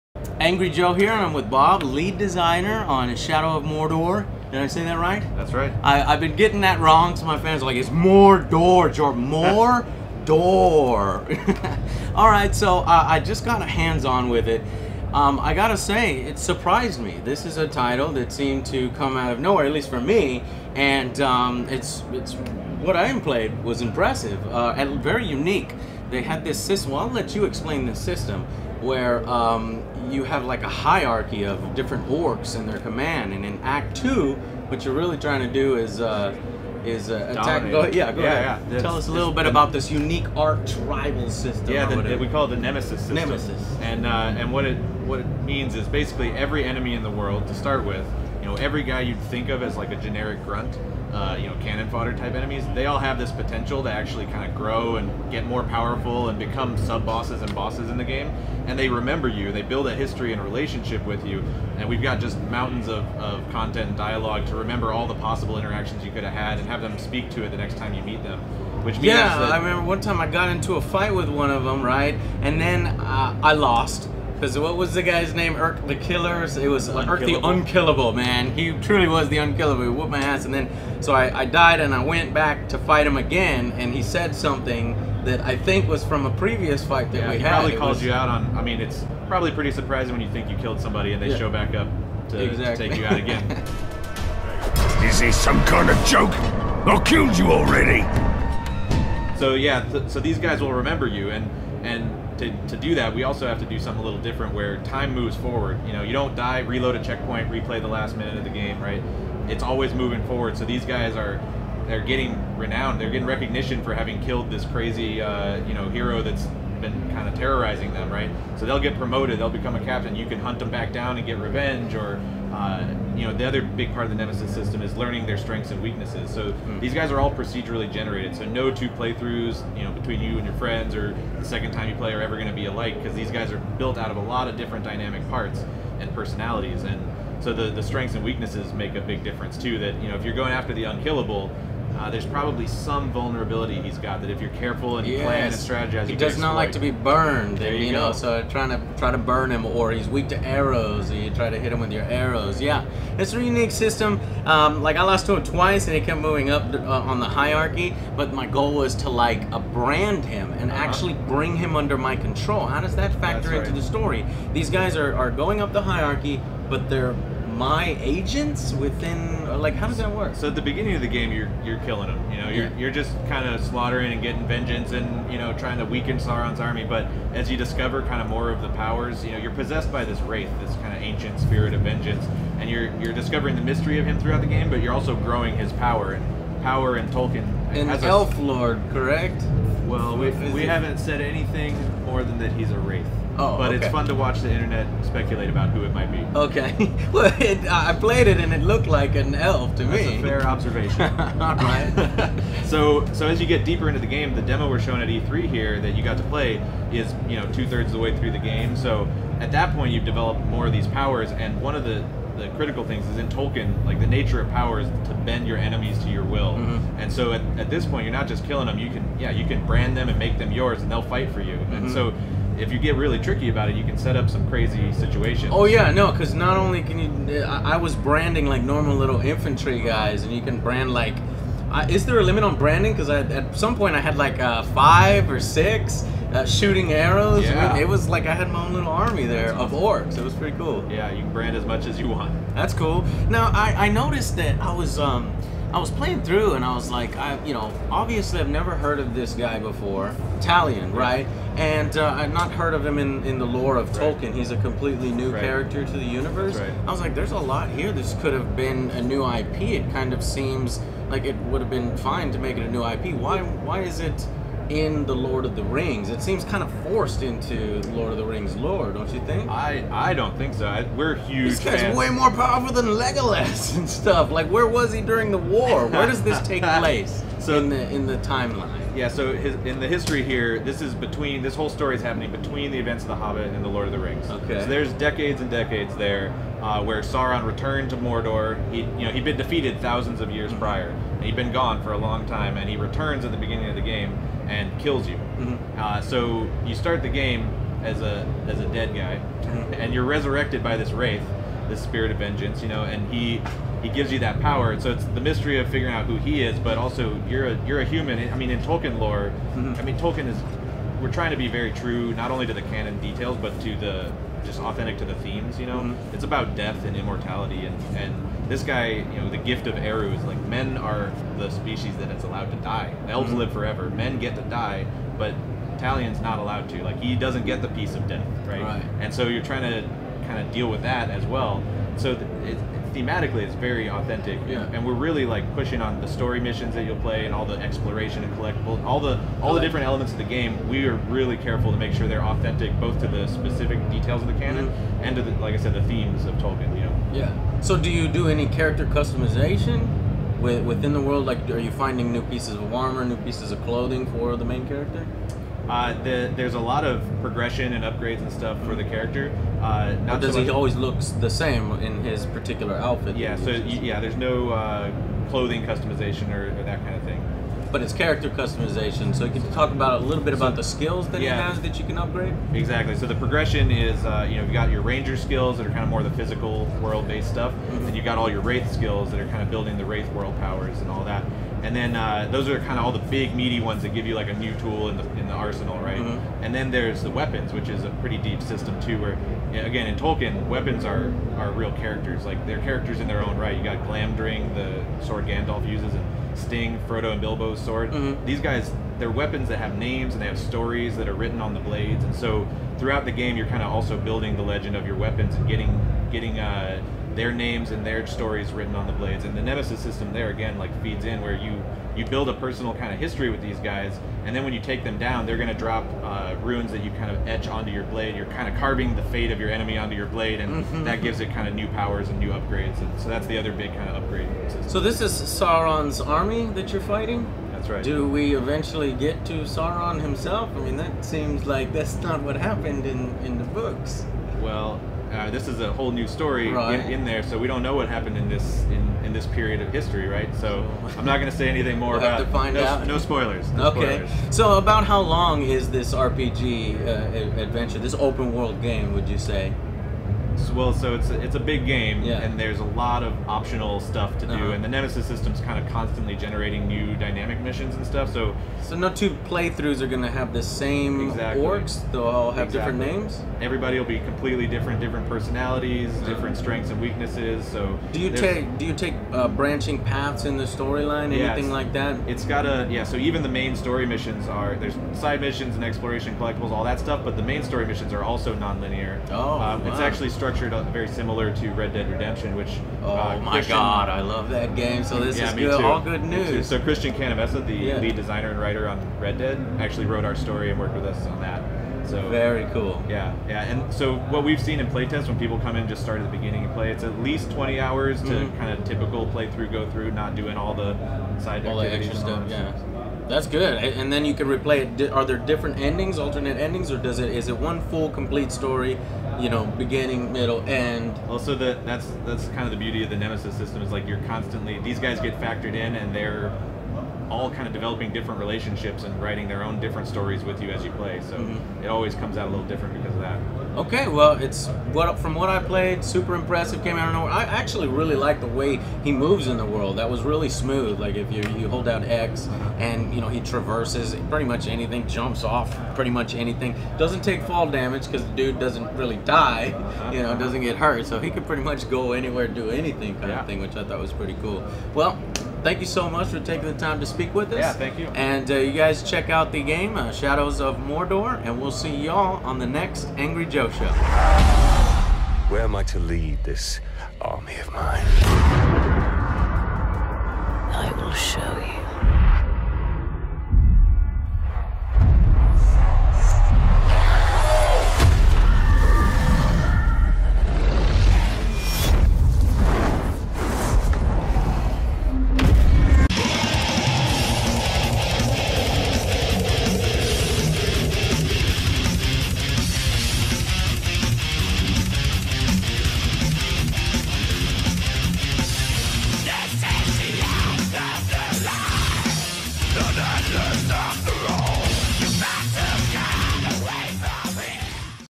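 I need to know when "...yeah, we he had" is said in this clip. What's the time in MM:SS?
01:27.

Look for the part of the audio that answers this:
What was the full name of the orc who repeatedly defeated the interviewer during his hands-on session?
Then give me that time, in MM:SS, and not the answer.
01:16.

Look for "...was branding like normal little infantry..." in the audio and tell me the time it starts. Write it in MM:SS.
03:47.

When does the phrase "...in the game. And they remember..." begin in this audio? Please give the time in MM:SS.
00:57.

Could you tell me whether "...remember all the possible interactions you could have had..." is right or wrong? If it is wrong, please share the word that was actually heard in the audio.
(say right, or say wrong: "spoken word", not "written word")
right.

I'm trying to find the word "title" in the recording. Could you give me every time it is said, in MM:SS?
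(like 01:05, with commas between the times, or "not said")
00:17.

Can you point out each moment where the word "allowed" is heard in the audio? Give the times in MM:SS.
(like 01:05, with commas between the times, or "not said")
05:22, 05:26.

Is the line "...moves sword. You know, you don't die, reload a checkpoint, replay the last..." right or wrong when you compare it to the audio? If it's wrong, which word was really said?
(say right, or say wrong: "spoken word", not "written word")
wrong: "forward", not "sword".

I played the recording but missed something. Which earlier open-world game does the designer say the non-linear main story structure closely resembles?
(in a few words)
Red Dead Redemption.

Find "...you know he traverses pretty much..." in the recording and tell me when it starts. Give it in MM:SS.
08:52.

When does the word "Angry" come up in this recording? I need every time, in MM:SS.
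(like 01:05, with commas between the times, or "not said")
00:00, 09:12.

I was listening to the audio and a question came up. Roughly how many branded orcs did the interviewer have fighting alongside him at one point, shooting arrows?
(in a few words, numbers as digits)
five or six.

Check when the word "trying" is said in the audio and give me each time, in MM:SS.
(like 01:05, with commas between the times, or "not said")
00:35, 02:28, 02:55, 05:11, 05:29.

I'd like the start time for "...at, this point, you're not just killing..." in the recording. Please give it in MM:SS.
03:37.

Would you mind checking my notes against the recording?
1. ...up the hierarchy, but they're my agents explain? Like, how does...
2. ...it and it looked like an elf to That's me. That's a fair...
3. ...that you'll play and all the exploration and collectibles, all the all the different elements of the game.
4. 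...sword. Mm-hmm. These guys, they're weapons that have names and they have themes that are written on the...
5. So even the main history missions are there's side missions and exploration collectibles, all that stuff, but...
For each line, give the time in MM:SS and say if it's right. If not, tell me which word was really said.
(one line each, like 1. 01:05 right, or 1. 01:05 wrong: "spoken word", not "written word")
1. 02:45 wrong: "within", not "explain"
2. 03:18 right
3. 05:36 right
4. 06:37 wrong: "stories", not "themes"
5. 07:52 wrong: "story", not "history".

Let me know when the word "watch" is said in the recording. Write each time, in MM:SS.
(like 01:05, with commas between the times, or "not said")
03:14.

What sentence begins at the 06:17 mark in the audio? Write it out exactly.
and you've got all your wraith skills that are kind of building the wraith world powers and all that.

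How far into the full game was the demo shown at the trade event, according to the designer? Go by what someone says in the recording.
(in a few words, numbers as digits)
two thirds.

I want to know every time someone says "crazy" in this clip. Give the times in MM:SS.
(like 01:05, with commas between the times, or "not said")
01:54, 03:44.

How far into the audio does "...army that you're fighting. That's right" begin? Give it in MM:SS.
07:05.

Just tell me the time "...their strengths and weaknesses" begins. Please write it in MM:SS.
02:05.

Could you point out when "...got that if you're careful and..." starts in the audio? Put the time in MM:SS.
02:23.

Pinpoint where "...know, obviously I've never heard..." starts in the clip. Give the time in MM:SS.
04:07.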